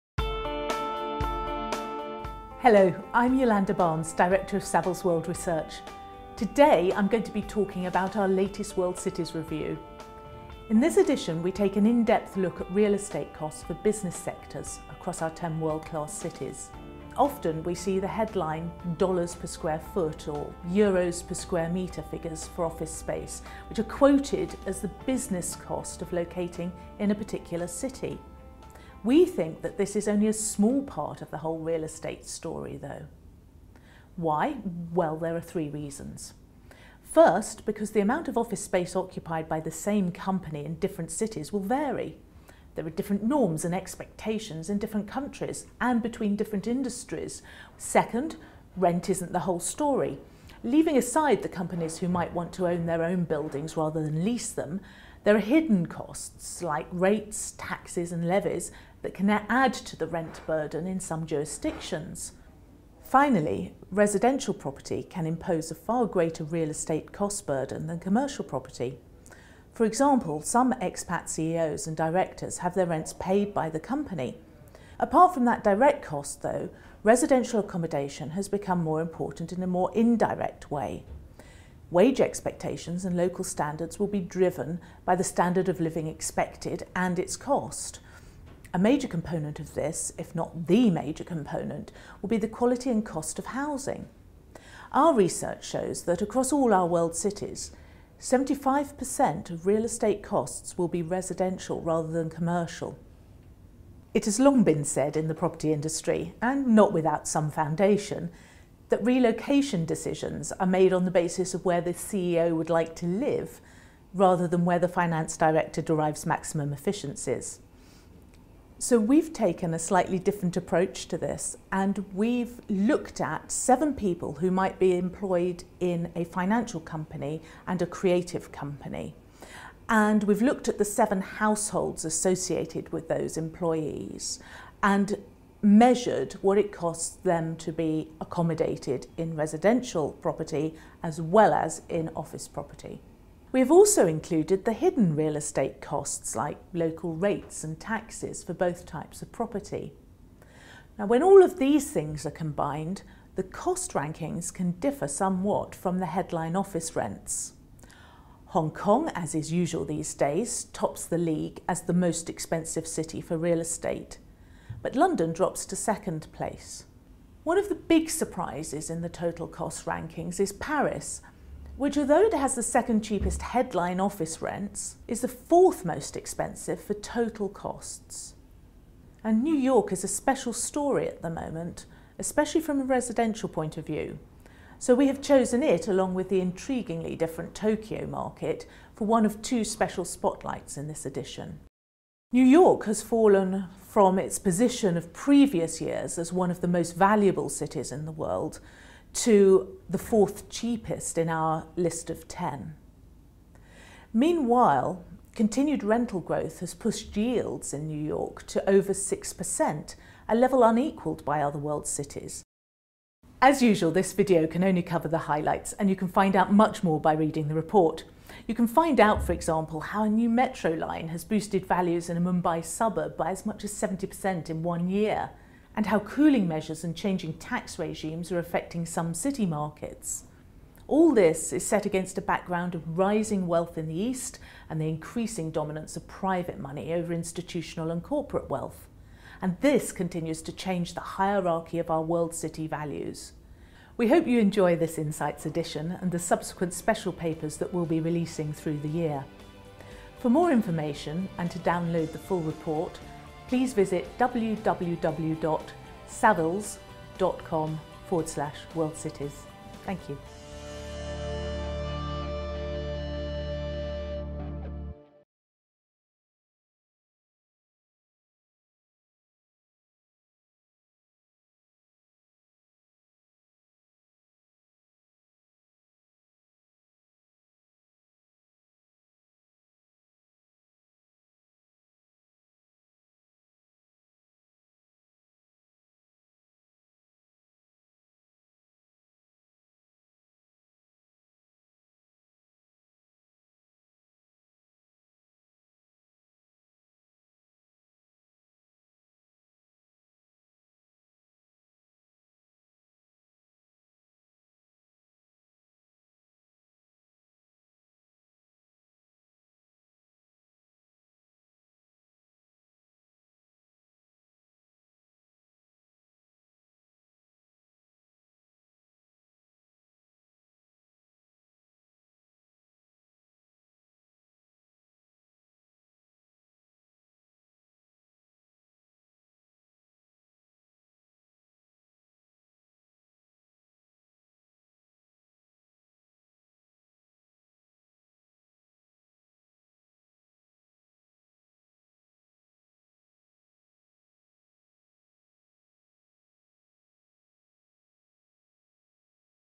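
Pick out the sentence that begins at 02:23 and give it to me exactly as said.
We have also included the hidden real estate costs like local rates and taxes for both types of property.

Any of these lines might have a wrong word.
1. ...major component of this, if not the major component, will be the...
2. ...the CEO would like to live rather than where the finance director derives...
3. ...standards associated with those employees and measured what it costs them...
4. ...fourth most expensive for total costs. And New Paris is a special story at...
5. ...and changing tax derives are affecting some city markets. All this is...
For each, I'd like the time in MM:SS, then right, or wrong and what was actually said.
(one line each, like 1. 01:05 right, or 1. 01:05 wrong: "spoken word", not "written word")
1. 01:28 right
2. 01:51 right
3. 02:11 wrong: "households", not "standards"
4. 02:55 wrong: "York", not "Paris"
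5. 03:46 wrong: "regimes", not "derives".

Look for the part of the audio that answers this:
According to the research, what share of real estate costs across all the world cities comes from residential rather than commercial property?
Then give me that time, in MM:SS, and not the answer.
01:38.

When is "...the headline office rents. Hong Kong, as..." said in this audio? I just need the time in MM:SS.
02:35.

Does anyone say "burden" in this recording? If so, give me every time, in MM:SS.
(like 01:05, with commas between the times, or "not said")
01:00, 01:07.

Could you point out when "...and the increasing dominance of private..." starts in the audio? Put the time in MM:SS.
03:54.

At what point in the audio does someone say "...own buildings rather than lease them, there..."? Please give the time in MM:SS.
00:53.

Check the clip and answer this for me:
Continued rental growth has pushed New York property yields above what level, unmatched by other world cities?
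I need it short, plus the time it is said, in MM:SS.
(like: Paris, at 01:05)
6%, at 03:28.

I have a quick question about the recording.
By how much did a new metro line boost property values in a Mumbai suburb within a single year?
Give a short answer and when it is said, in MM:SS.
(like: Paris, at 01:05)
70%, at 03:43.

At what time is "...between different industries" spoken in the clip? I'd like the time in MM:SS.
00:46.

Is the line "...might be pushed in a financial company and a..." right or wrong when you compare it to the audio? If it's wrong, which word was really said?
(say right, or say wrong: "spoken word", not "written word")
wrong: "employed", not "pushed".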